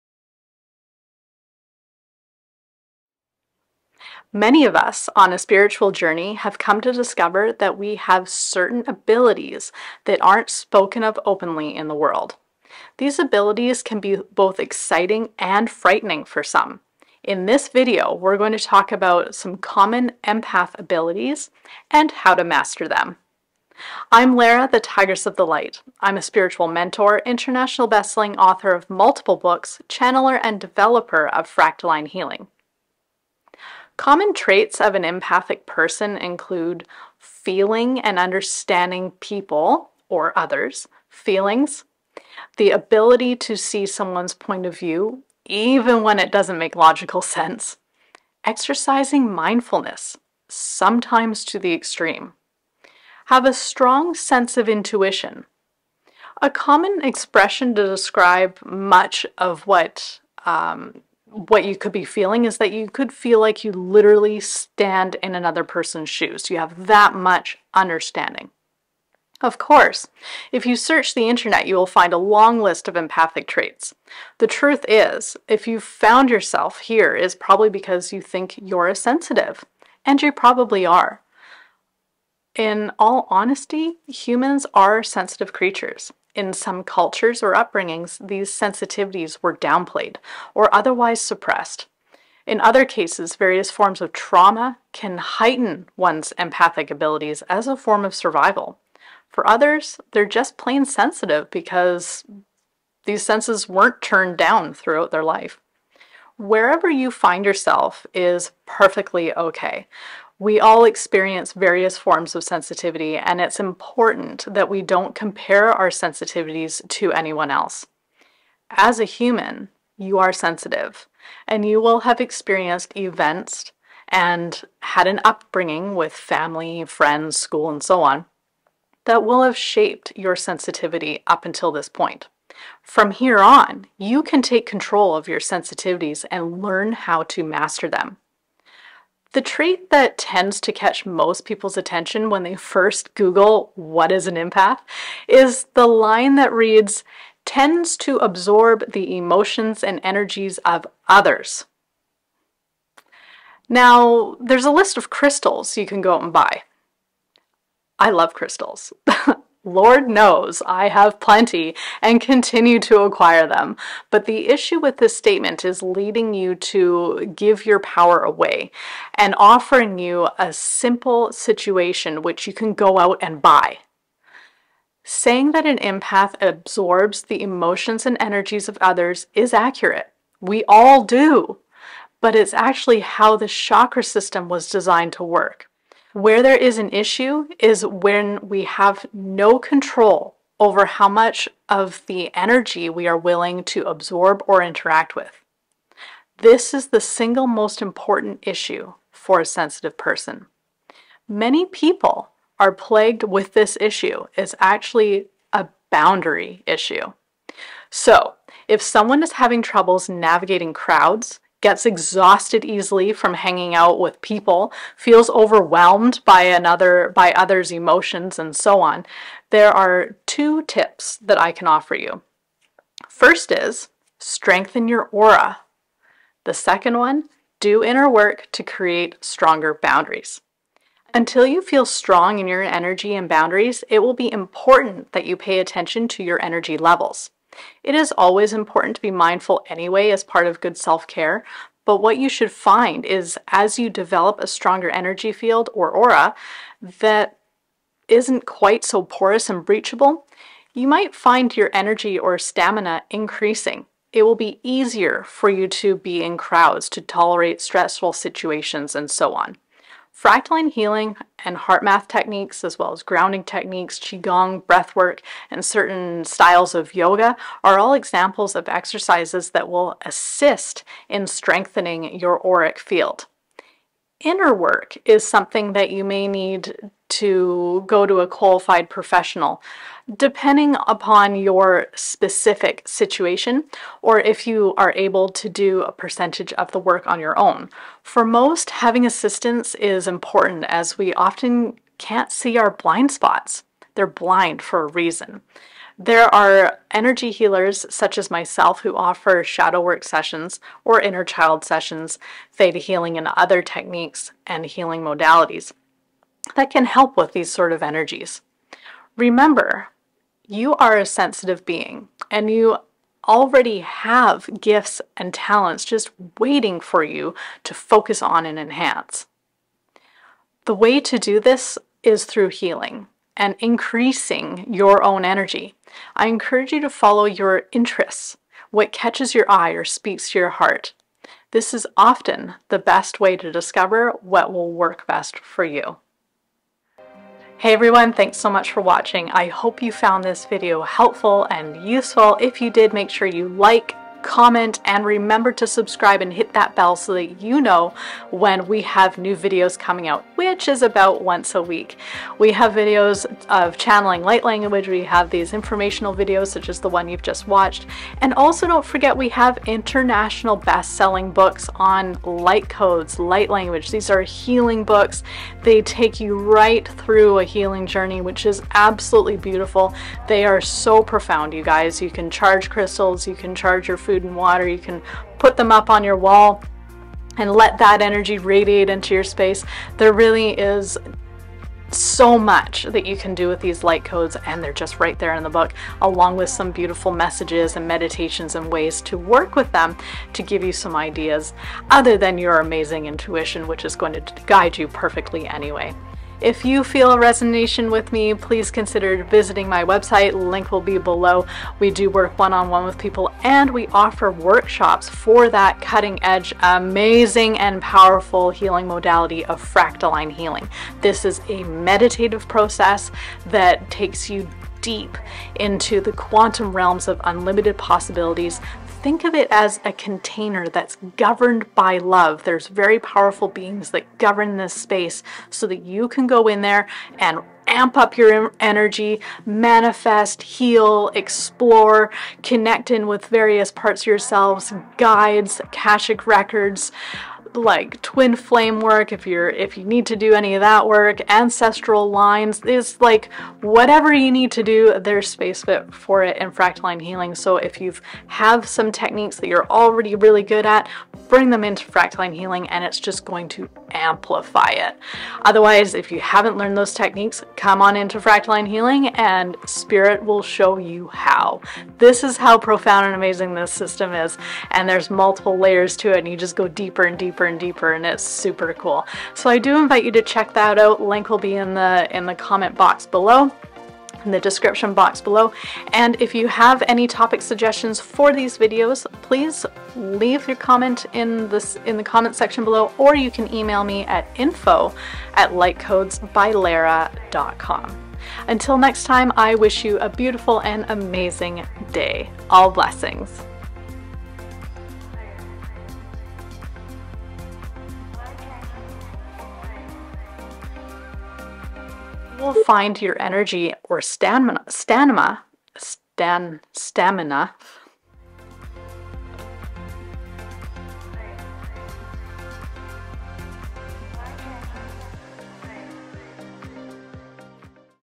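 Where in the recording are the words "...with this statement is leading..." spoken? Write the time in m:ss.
2:44.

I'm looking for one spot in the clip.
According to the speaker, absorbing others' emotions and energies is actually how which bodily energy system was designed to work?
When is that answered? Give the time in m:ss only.
3:03.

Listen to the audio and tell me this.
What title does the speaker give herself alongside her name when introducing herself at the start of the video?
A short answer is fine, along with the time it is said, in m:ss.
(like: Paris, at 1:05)
Tigress of the Light, at 0:24.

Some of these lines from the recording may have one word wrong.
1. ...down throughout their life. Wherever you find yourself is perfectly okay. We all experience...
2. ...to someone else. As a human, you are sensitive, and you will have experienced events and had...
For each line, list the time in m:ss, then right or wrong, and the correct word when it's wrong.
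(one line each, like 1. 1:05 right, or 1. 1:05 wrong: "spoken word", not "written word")
1. 1:44 right
2. 1:56 wrong: "anyone", not "someone".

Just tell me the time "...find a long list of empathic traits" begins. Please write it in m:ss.
1:11.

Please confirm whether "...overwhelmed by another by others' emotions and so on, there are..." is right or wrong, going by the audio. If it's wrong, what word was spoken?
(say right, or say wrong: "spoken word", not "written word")
right.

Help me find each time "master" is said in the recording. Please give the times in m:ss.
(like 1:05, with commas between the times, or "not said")
0:22, 2:17.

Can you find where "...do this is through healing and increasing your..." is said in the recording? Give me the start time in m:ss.
5:21.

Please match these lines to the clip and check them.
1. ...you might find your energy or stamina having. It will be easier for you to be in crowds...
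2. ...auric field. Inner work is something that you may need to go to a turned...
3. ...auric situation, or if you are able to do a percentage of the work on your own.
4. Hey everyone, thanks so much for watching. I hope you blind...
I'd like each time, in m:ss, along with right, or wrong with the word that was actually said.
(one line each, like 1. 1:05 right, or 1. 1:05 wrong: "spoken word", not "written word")
1. 4:10 wrong: "increasing", not "having"
2. 4:32 wrong: "qualified", not "turned"
3. 4:41 wrong: "specific", not "auric"
4. 5:37 wrong: "found", not "blind".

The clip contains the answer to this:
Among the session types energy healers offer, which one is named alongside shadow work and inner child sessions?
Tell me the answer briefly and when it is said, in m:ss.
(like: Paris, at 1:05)
Theta healing, at 5:02.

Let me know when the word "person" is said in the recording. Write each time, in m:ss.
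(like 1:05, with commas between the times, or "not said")
0:35, 1:05, 3:19.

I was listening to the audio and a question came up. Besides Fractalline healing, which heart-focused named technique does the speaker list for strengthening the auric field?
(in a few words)
HeartMath.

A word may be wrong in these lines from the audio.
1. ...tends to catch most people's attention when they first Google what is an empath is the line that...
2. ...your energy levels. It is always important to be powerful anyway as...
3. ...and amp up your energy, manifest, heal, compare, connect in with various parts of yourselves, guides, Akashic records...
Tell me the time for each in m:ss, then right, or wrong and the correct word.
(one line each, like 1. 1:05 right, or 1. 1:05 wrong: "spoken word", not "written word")
1. 2:20 right
2. 3:56 wrong: "mindful", not "powerful"
3. 7:07 wrong: "explore", not "compare".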